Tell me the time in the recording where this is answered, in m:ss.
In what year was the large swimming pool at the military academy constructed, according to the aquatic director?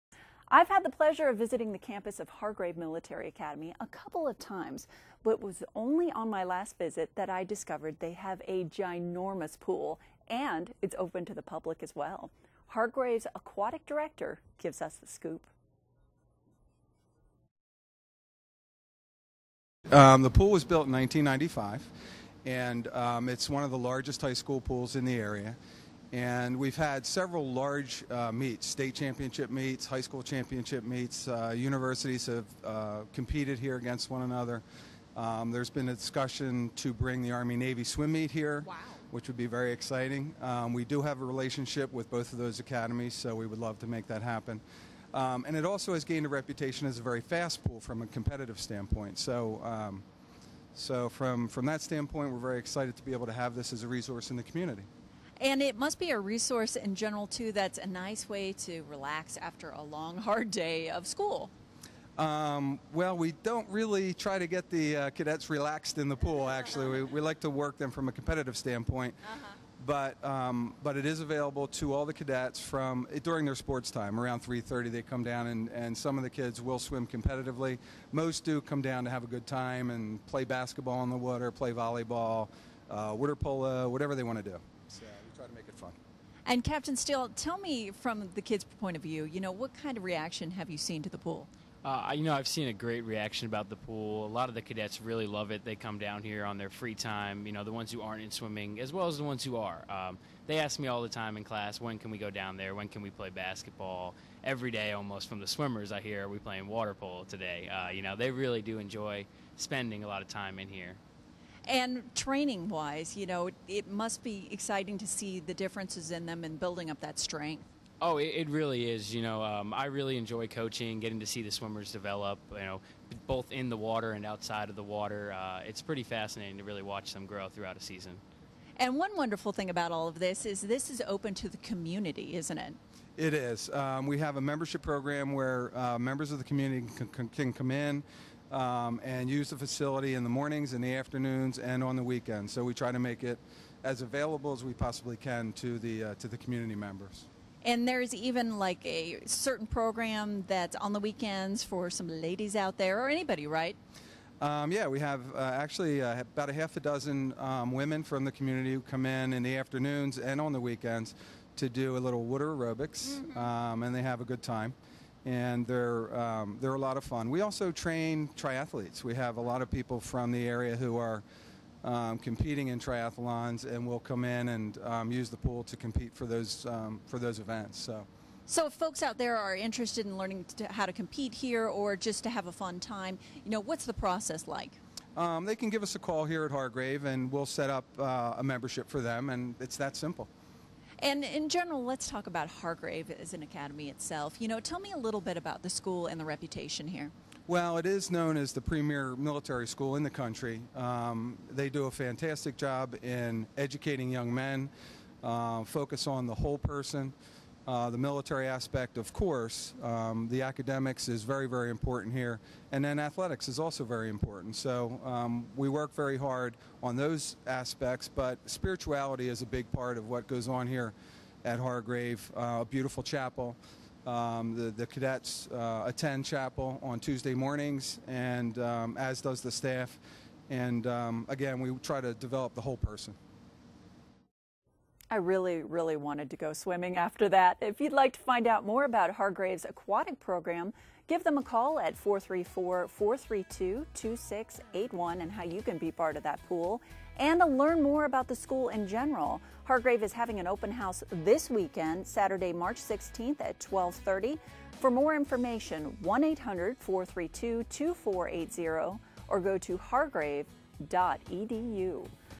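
0:20.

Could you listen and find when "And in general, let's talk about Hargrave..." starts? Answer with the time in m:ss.
3:11.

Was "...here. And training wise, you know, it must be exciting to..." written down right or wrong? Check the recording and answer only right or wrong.
right.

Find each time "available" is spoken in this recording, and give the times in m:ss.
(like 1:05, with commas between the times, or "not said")
1:11, 2:24.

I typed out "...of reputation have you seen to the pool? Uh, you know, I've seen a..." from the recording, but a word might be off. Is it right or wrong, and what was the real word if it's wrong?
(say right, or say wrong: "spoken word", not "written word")
wrong: "reaction", not "reputation".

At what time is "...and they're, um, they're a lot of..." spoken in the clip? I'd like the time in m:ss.
2:45.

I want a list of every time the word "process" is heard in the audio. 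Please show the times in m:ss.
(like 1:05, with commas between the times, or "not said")
3:03.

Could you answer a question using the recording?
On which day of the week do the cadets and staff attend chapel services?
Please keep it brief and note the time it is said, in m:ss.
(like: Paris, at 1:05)
Tuesday, at 3:46.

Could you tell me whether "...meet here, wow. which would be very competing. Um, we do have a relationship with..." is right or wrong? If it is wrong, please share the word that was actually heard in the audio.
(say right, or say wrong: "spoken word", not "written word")
wrong: "exciting", not "competing".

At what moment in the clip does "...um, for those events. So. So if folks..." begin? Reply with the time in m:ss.
2:56.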